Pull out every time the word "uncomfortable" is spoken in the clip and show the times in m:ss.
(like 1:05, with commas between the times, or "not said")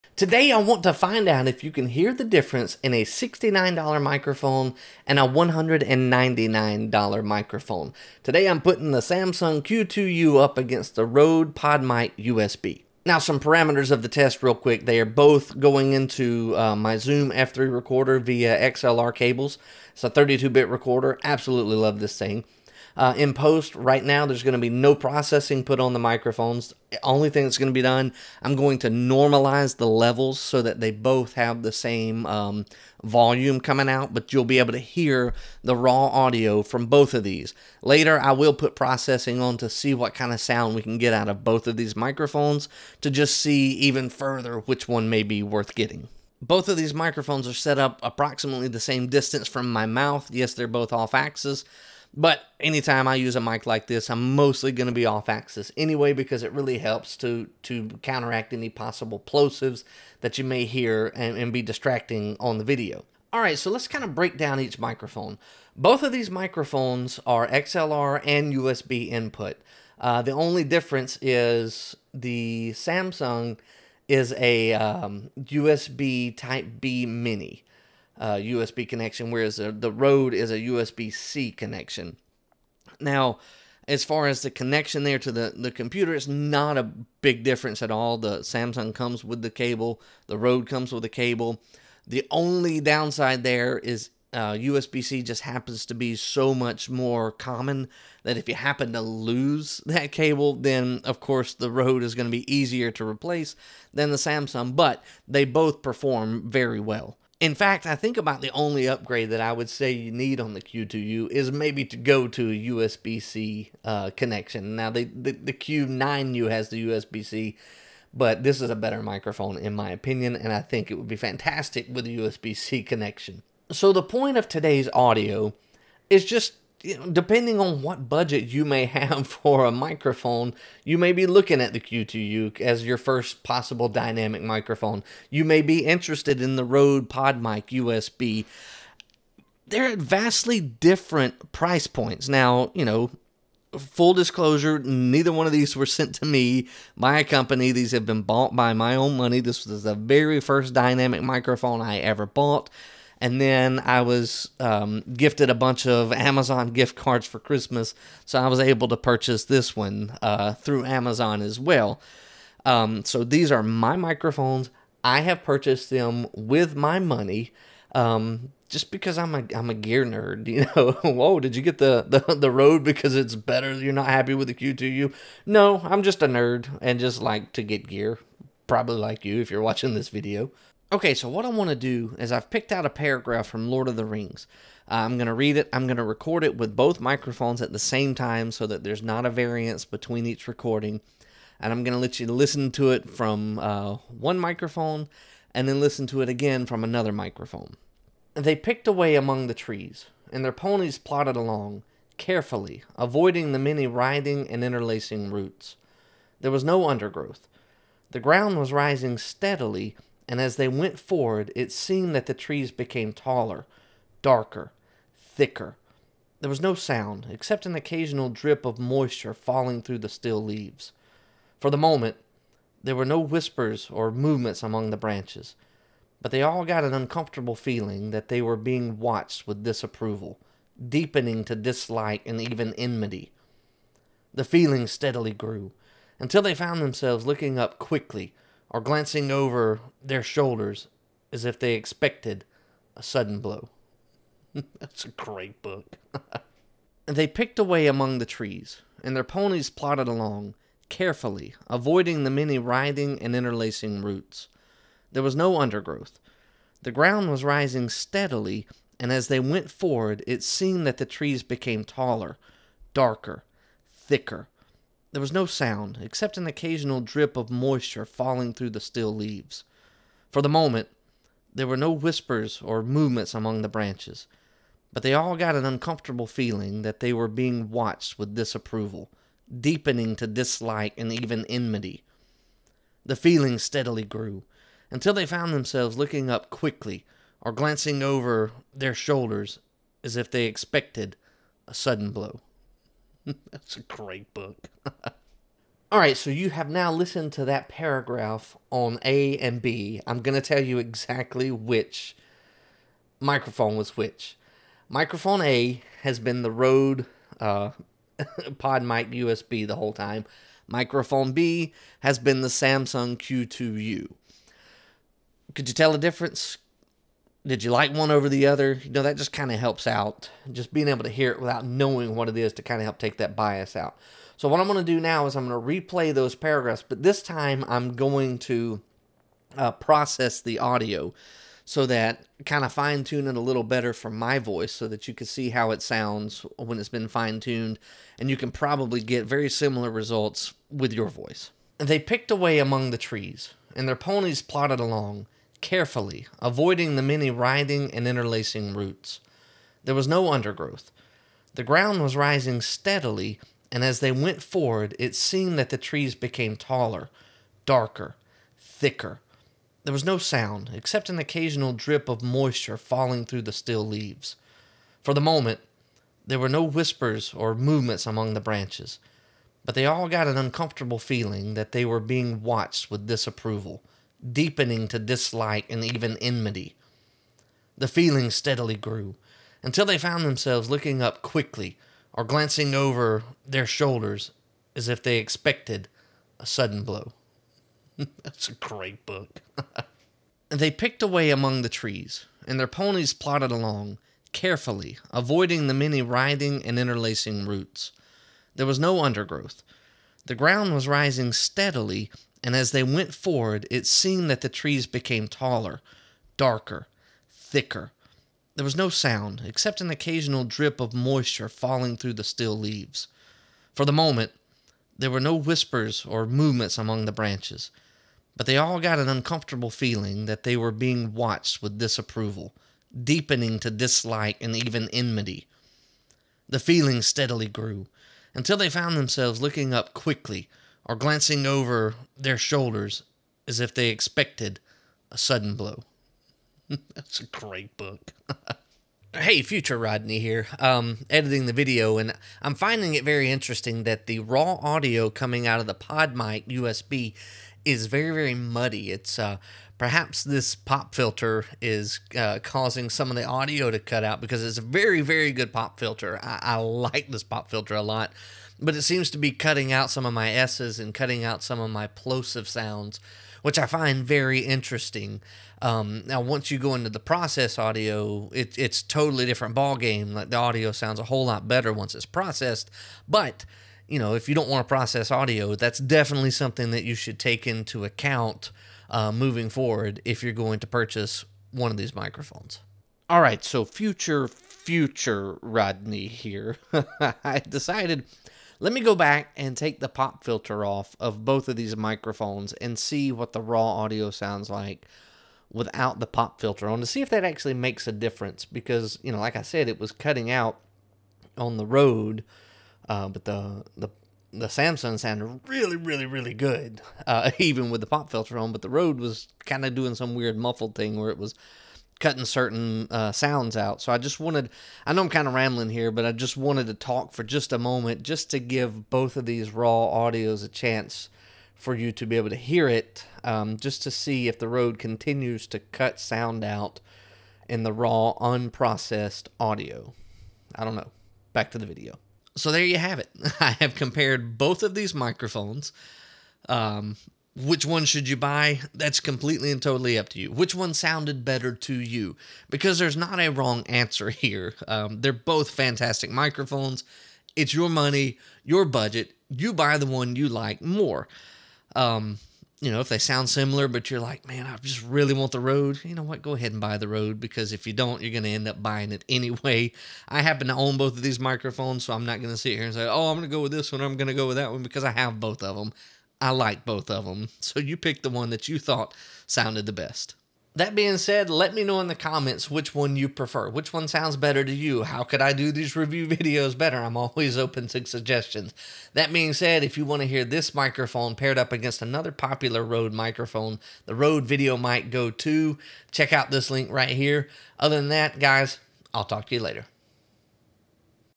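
3:46, 4:35, 6:10, 6:59.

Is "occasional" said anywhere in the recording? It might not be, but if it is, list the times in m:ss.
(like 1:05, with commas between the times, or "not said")
3:37, 4:26, 6:01, 6:49.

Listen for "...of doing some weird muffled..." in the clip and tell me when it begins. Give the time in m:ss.
8:29.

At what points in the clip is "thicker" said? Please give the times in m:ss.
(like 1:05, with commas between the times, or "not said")
3:35, 4:23, 5:58, 6:47.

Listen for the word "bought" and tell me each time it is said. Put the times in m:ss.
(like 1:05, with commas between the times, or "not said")
2:28, 2:32.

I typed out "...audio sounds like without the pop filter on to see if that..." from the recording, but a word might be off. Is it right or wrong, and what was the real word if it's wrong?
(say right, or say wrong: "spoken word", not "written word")
right.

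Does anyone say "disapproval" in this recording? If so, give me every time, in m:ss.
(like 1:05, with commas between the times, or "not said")
3:49, 4:38, 6:13, 7:01.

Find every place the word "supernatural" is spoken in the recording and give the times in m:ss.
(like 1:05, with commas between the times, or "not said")
not said.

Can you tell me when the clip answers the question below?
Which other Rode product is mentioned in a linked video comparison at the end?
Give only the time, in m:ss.
9:43.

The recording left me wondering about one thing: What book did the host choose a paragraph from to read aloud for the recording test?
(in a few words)
Lord of the Rings.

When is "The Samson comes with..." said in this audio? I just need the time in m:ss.
1:28.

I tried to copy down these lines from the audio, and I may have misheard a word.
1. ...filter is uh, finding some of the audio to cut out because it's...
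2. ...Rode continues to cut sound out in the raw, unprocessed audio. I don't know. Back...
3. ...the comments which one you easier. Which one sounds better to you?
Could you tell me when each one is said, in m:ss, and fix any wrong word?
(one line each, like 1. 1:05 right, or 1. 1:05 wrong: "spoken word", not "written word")
1. 7:30 wrong: "causing", not "finding"
2. 8:44 right
3. 9:31 wrong: "prefer", not "easier".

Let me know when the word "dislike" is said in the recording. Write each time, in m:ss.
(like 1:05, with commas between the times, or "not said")
3:51, 4:40, 6:14, 7:03.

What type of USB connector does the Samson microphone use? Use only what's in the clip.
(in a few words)
USB Type B Mini.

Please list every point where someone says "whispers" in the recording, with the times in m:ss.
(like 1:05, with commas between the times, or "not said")
3:43, 4:31, 6:06, 6:55.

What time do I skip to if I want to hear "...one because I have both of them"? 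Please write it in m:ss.
9:24.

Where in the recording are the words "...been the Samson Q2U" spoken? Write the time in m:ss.
5:12.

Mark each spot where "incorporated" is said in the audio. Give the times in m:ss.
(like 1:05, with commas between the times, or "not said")
not said.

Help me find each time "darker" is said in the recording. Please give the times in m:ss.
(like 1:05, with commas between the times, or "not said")
3:34, 4:22, 5:57, 6:46.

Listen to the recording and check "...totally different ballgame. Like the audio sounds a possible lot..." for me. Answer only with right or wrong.
wrong.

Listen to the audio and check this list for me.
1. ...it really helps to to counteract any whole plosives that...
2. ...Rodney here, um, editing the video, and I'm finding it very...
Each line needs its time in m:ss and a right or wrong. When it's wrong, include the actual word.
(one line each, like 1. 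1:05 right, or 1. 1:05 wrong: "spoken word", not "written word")
1. 0:56 wrong: "possible", not "whole"
2. 7:19 right.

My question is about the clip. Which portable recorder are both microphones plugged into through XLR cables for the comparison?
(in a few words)
Zoom F3.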